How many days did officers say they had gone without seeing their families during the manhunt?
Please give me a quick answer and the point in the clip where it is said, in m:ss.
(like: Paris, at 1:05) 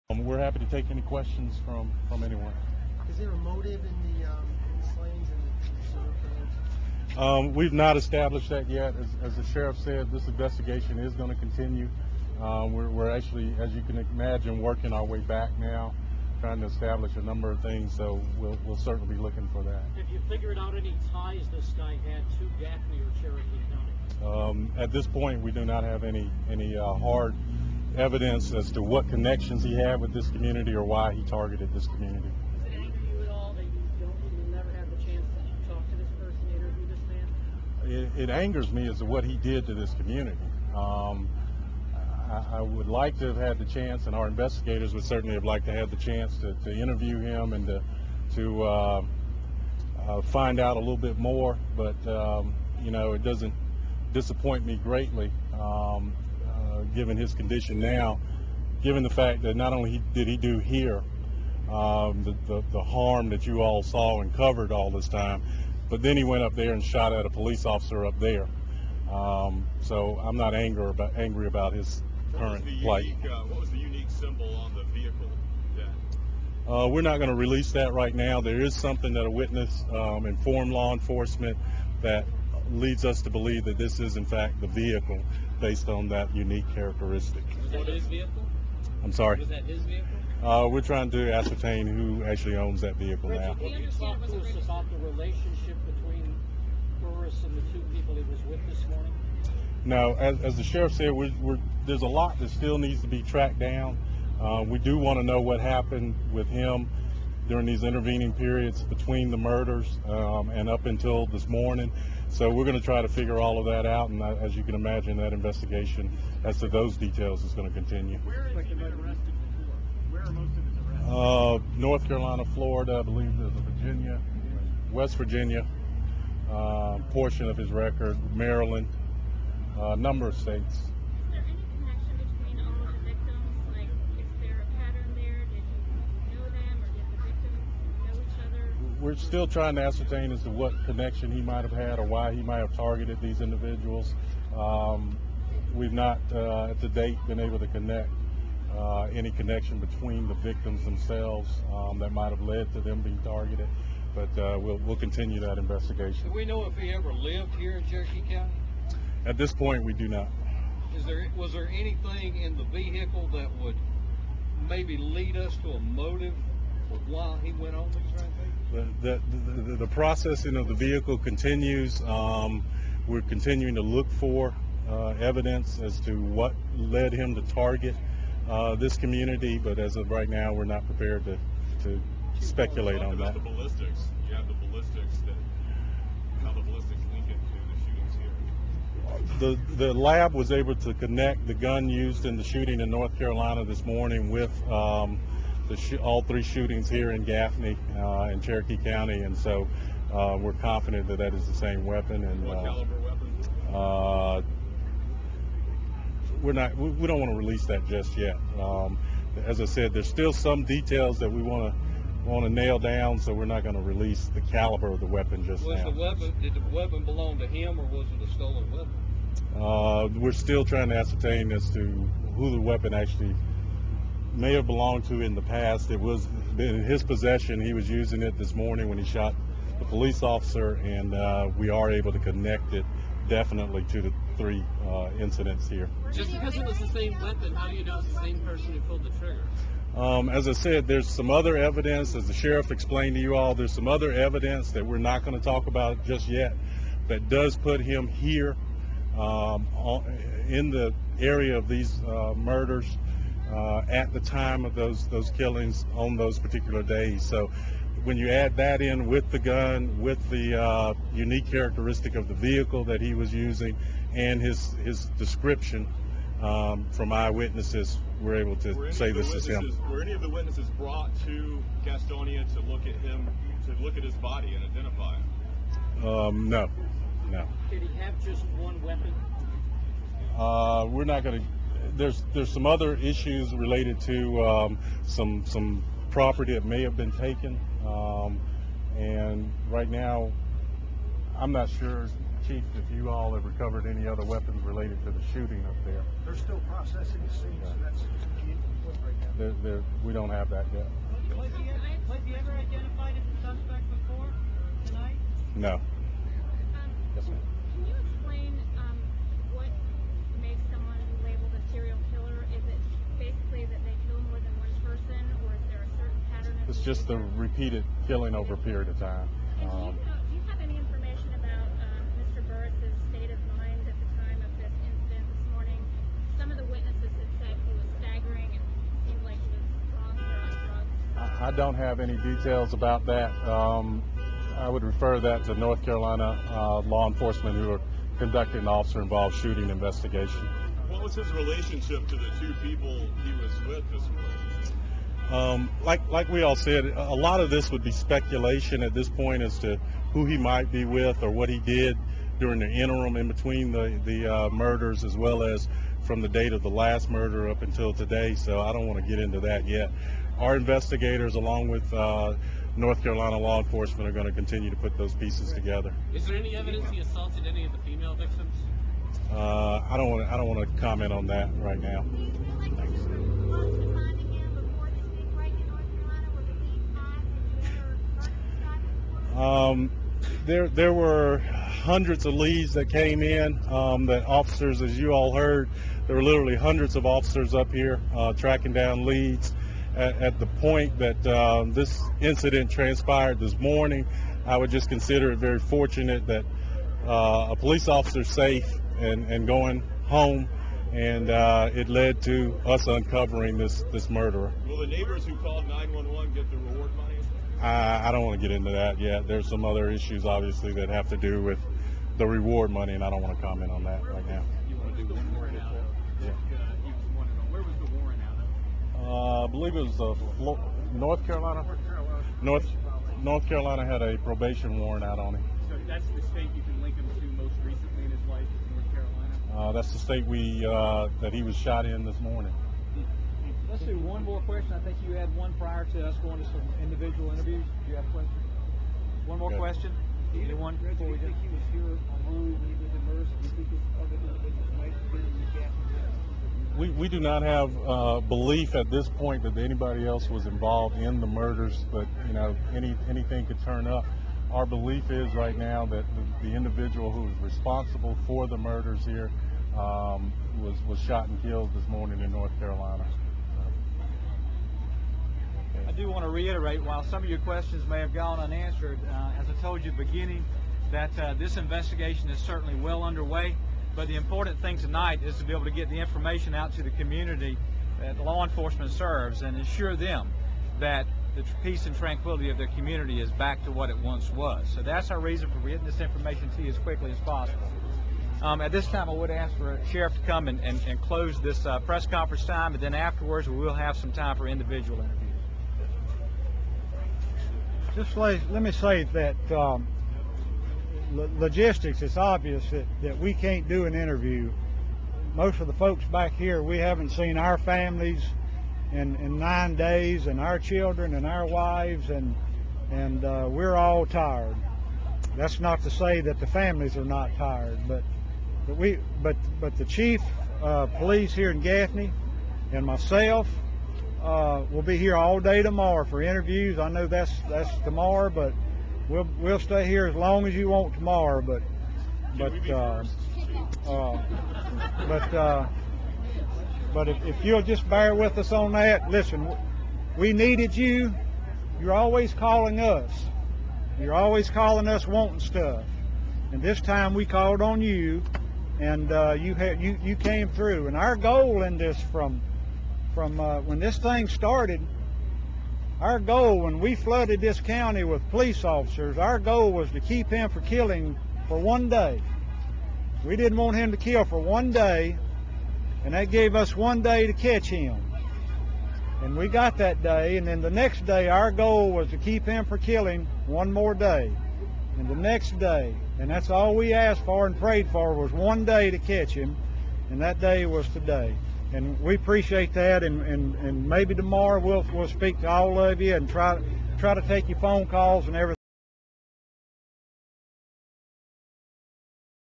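9, at 8:29.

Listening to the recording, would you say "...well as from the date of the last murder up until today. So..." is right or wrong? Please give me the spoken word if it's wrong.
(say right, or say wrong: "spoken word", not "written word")
right.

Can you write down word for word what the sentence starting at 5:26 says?
Some of the witnesses had said he was staggering and seemed like he was drunk or on drugs.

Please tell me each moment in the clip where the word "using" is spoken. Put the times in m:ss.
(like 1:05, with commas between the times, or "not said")
3:47, 4:23.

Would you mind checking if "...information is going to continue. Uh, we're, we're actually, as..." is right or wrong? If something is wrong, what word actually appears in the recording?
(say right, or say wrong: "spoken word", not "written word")
wrong: "investigation", not "information".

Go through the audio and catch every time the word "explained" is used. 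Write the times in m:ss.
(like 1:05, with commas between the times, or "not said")
4:02.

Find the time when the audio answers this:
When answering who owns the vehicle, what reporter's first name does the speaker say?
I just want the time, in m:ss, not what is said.
1:33.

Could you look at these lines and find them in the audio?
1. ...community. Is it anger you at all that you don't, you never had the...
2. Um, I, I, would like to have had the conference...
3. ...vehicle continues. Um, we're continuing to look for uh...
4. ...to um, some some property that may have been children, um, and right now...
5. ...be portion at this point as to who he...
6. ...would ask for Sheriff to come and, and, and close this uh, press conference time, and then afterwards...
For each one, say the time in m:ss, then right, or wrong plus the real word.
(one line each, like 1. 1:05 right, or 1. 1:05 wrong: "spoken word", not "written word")
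1. 0:31 right
2. 0:40 wrong: "chance", not "conference"
3. 2:50 right
4. 4:44 wrong: "taken", not "children"
5. 5:47 wrong: "speculation", not "portion"
6. 8:09 right.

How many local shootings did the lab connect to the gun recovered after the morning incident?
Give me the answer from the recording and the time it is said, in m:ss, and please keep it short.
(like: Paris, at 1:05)
3, at 3:16.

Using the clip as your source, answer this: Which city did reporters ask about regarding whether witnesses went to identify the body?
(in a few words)
Gastonia.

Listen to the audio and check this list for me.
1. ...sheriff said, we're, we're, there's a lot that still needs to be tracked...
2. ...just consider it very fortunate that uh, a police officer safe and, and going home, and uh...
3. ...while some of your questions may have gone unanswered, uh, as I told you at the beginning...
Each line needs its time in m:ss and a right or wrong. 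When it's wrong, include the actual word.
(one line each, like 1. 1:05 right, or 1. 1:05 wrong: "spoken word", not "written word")
1. 1:40 right
2. 6:34 right
3. 7:46 right.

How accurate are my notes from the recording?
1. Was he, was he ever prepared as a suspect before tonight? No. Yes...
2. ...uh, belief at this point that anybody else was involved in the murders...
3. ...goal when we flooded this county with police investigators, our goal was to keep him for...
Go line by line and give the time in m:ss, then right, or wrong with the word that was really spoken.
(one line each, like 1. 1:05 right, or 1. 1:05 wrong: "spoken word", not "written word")
1. 5:01 wrong: "identified", not "prepared"
2. 7:27 right
3. 9:16 wrong: "officers", not "investigators".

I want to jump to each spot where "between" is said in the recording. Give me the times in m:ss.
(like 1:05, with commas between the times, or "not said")
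1:35, 1:48, 2:29, 5:53.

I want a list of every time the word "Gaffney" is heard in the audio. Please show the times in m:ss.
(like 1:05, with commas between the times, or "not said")
0:22, 3:17, 8:41.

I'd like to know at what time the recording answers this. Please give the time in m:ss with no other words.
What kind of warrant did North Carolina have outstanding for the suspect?
7:04.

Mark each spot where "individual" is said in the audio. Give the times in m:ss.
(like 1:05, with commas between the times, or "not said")
2:23, 7:16, 7:24, 7:36, 8:14.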